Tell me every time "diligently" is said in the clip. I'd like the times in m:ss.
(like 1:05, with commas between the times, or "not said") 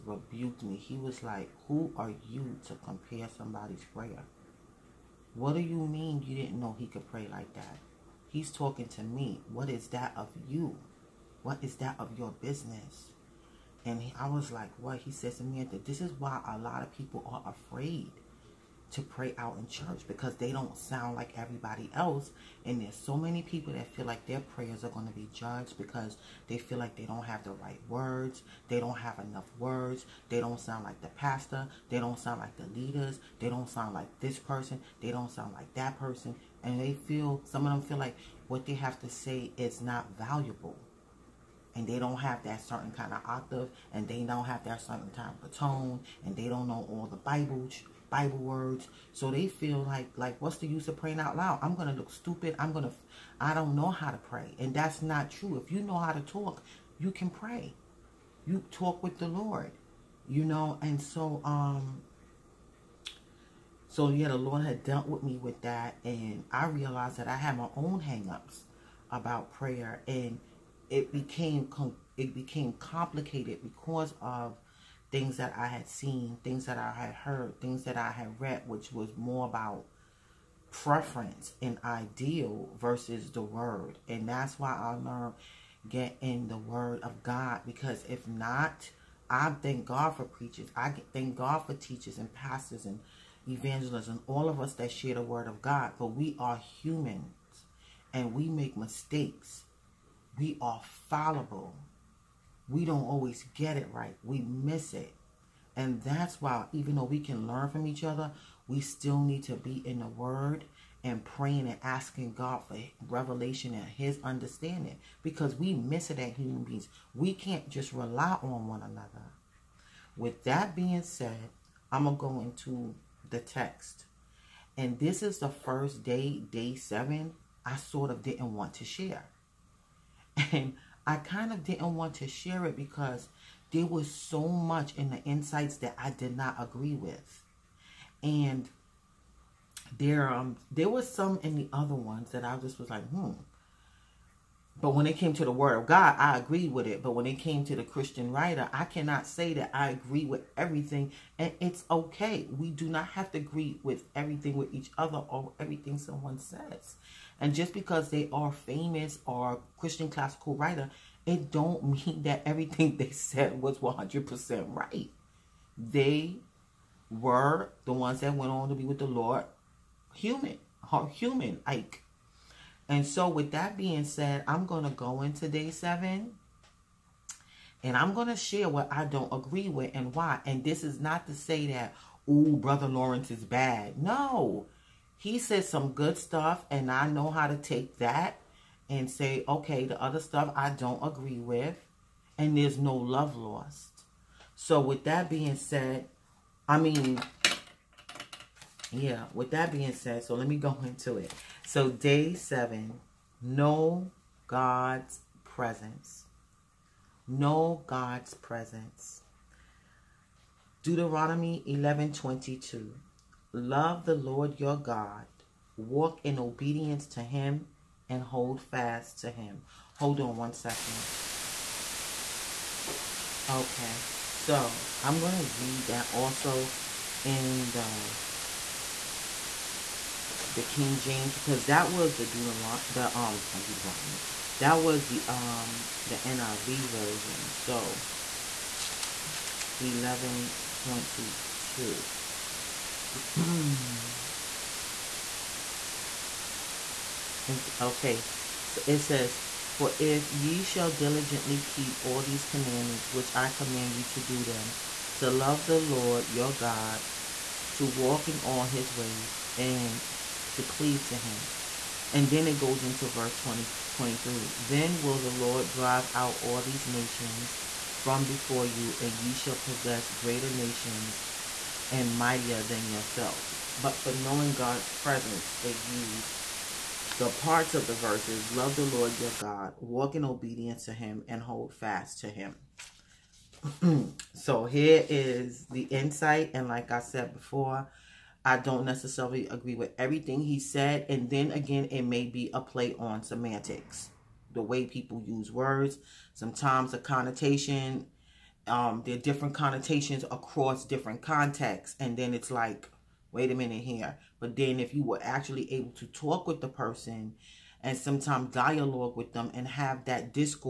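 4:10.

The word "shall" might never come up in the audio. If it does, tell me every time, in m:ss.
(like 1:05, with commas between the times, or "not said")
4:10, 4:29.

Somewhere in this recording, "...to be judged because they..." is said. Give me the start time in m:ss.
0:25.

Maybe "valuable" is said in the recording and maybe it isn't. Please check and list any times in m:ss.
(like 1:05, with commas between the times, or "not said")
0:40.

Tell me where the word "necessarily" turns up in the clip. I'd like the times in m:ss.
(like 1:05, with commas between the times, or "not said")
4:48.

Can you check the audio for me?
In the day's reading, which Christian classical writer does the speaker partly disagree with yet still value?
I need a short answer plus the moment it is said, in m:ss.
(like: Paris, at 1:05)
Brother Lawrence, at 3:02.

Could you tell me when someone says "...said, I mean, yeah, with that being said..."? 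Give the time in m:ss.
3:15.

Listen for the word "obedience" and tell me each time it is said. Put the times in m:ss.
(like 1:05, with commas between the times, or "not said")
3:36, 4:40.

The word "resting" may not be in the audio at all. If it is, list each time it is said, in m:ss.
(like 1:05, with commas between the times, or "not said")
not said.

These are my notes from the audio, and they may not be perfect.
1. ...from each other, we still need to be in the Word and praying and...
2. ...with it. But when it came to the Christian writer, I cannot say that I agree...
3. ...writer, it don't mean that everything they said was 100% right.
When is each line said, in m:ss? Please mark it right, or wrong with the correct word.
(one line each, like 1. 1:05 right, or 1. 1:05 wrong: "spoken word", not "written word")
1. 1:47 right
2. 2:26 right
3. 2:40 right.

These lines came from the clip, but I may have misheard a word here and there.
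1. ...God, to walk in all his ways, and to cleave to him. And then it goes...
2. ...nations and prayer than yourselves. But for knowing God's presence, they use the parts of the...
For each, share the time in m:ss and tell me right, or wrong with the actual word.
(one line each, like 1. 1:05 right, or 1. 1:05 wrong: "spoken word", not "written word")
1. 4:16 right
2. 4:30 wrong: "mightier", not "prayer".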